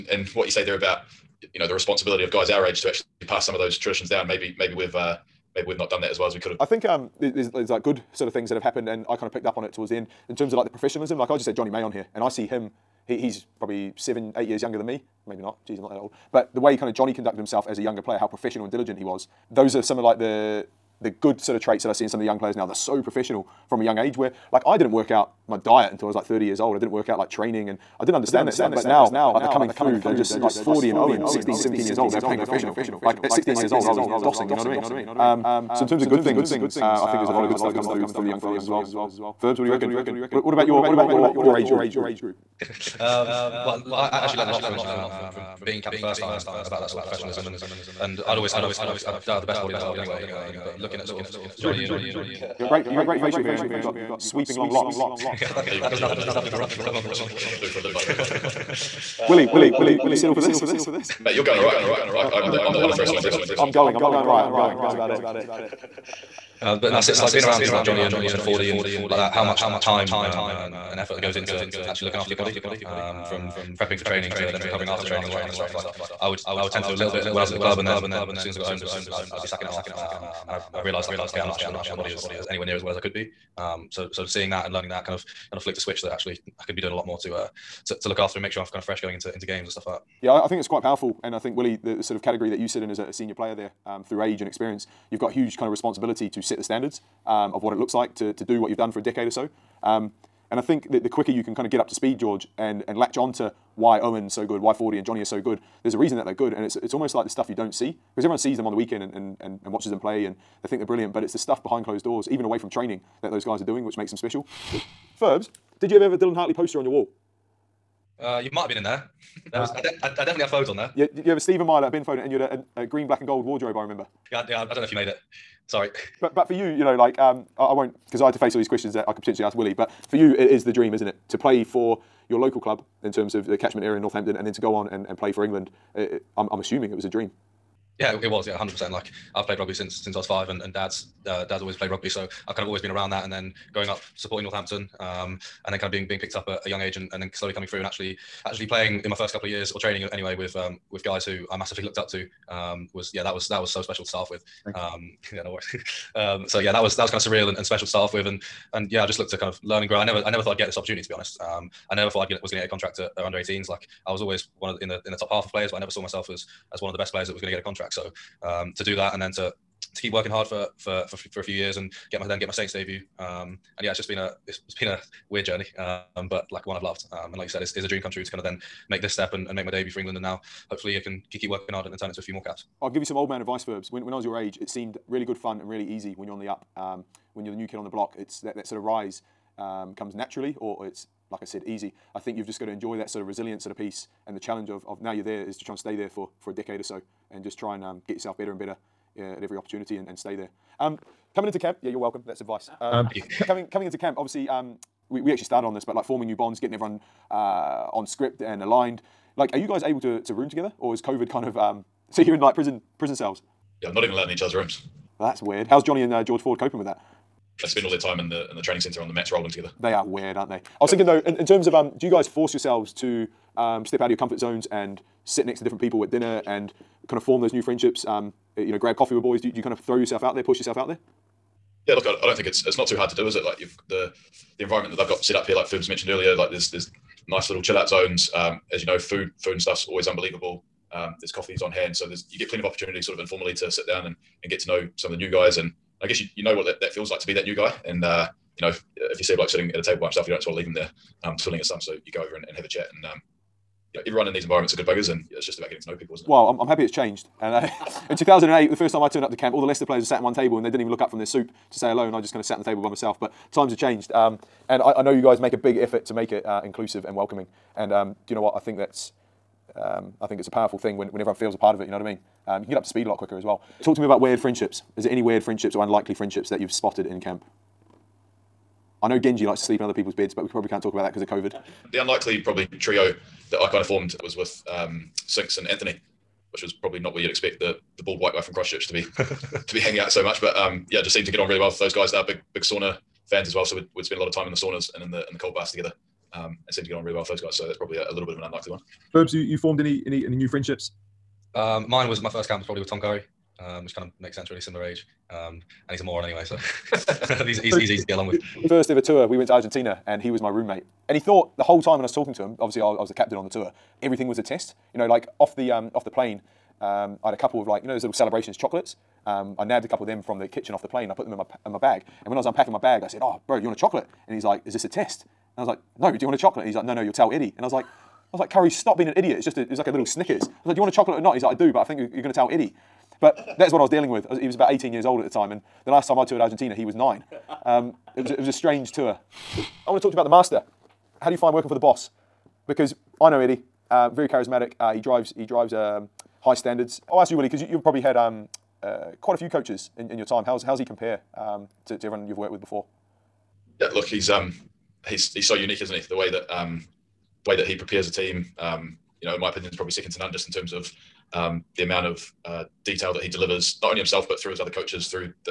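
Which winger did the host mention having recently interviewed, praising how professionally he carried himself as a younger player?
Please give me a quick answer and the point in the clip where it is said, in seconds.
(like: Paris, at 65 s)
Jonny May, at 11 s.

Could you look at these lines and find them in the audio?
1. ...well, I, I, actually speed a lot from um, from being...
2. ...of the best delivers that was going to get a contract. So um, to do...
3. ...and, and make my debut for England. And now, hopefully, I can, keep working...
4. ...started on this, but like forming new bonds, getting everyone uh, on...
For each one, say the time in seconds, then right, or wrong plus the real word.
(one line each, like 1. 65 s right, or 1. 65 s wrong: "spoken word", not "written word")
1. 43 s wrong: "learned", not "speed"
2. 166 s wrong: "players", not "delivers"
3. 179 s right
4. 205 s right.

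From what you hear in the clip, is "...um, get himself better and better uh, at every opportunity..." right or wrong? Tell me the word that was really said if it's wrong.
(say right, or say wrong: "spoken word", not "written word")
wrong: "yourself", not "himself".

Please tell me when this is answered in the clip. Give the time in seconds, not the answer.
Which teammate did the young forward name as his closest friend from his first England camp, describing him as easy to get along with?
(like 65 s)
302 s.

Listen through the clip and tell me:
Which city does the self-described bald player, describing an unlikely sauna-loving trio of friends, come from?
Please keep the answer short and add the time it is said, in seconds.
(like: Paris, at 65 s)
Christchurch, at 288 s.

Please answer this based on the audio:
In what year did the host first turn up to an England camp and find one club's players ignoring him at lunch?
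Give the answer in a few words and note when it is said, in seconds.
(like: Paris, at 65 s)
2008, at 258 s.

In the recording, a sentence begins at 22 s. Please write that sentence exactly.
They're so professional from a young age where like I didn't work out my diet until I was like 30 years old.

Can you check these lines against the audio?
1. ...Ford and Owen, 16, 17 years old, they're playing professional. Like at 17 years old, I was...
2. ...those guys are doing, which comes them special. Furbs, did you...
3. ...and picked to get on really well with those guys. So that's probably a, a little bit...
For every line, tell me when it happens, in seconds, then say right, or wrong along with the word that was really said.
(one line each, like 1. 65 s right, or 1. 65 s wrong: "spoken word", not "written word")
1. 30 s wrong: "16", not "17"
2. 113 s wrong: "makes", not "comes"
3. 296 s wrong: "seemed", not "picked".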